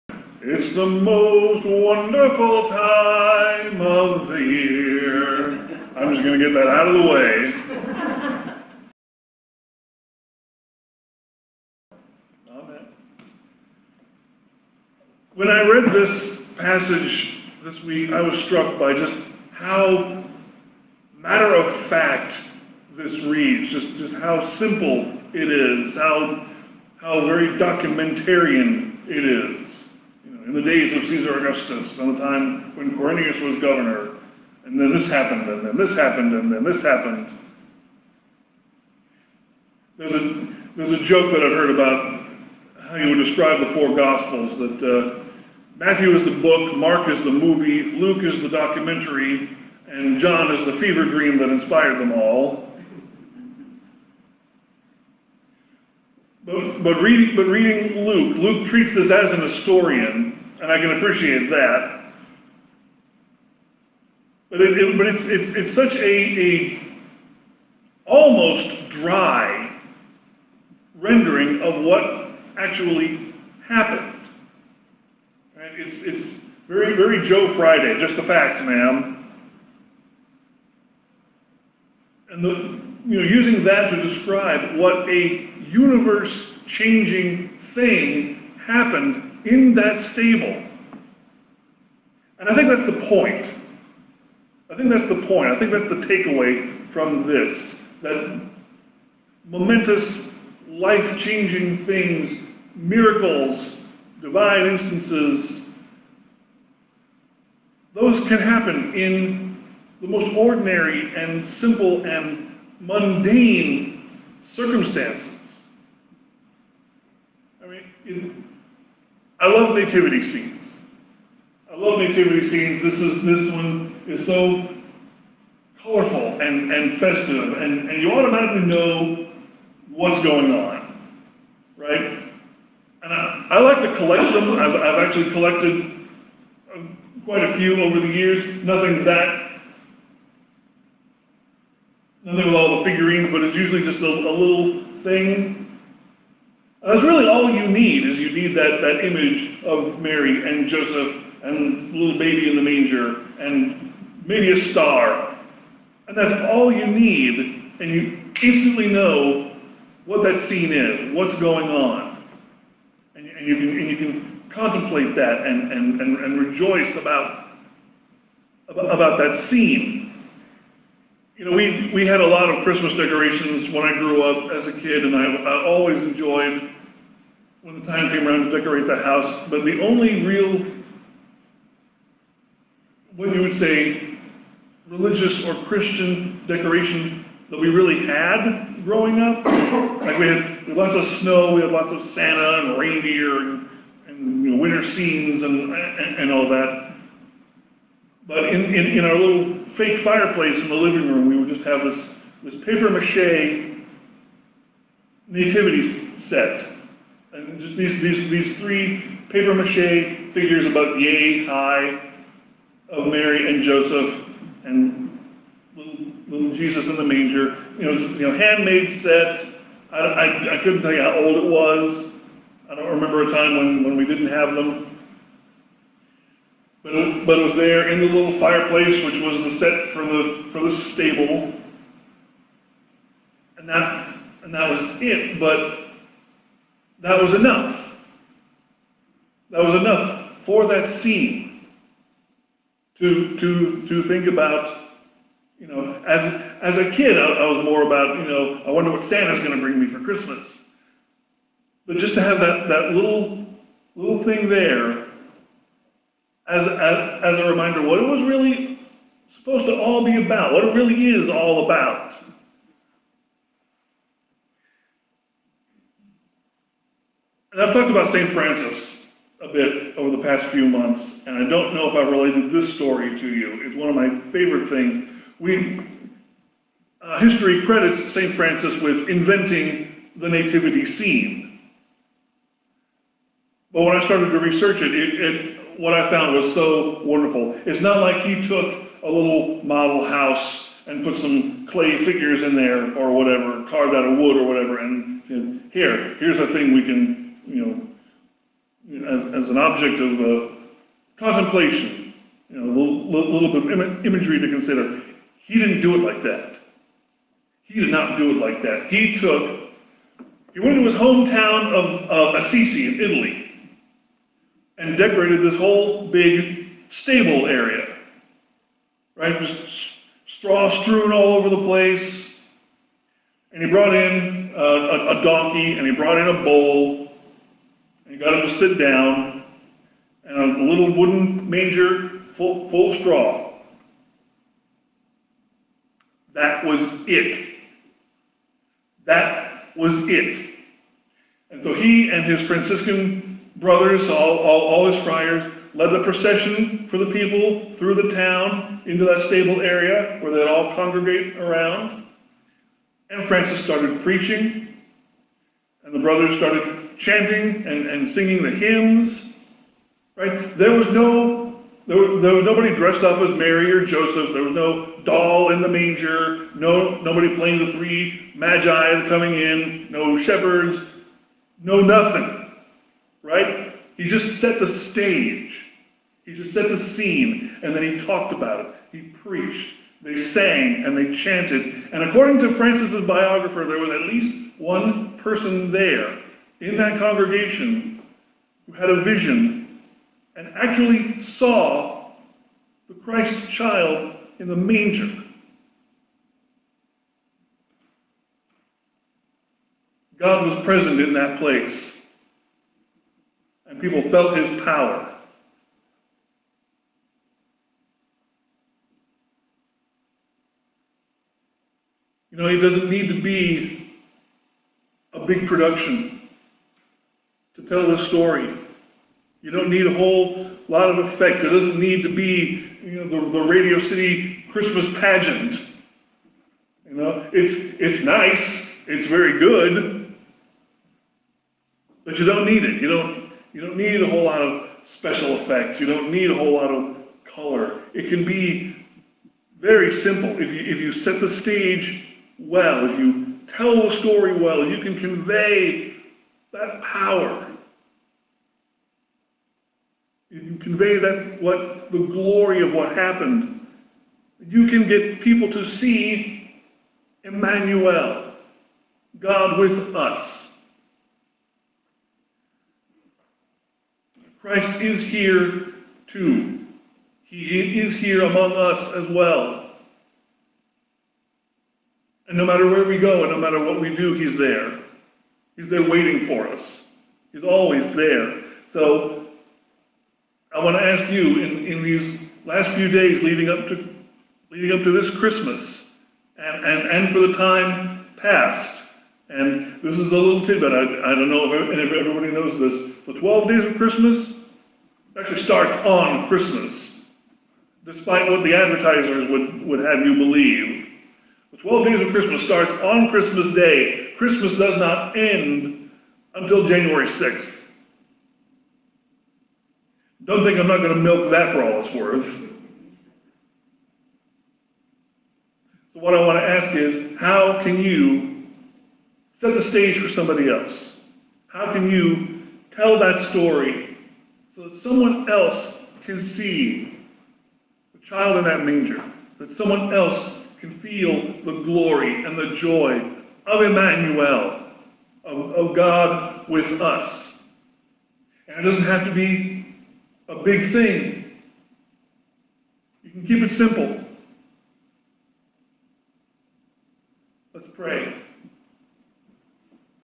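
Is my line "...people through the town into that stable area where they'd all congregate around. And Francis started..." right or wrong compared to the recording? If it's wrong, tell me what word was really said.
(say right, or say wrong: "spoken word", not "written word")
right.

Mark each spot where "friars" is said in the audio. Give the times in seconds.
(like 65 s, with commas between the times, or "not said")
345 s.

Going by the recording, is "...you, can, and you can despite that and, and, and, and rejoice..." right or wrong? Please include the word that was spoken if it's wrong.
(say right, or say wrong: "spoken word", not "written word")
wrong: "contemplate", not "despite".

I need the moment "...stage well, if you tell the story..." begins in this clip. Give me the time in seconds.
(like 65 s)
441 s.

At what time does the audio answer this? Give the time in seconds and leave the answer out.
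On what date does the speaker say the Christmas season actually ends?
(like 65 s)
506 s.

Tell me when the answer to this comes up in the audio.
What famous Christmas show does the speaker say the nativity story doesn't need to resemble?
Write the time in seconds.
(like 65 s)
423 s.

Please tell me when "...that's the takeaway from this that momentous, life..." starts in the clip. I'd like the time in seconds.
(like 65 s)
95 s.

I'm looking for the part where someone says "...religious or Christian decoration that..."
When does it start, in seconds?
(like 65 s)
184 s.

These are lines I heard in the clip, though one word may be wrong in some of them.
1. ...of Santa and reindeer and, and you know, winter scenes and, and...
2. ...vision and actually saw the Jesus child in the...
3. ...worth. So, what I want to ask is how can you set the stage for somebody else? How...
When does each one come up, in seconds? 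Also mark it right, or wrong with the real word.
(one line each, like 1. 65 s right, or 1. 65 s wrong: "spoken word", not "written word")
1. 191 s right
2. 389 s wrong: "Christ", not "Jesus"
3. 511 s right.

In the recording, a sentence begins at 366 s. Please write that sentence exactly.
No nobody playing the three magi coming in.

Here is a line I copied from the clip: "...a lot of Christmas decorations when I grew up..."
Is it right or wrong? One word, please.
right.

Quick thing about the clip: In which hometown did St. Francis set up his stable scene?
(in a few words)
Assisi.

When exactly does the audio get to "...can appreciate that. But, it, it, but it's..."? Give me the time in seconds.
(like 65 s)
60 s.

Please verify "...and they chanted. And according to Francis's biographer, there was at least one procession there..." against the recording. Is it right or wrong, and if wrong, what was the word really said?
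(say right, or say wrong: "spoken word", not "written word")
wrong: "person", not "procession".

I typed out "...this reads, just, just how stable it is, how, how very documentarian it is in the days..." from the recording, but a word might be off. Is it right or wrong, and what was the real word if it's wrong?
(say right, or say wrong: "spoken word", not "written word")
wrong: "simple", not "stable".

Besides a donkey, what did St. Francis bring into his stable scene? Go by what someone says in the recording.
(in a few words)
A bowl.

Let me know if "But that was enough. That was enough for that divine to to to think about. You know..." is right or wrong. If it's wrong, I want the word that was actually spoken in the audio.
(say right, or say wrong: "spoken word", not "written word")
wrong: "scene", not "divine".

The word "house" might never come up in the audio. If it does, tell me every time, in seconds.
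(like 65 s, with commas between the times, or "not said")
178 s, 290 s.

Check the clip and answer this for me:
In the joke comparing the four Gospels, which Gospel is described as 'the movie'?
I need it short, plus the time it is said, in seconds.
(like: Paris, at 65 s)
Mark, at 46 s.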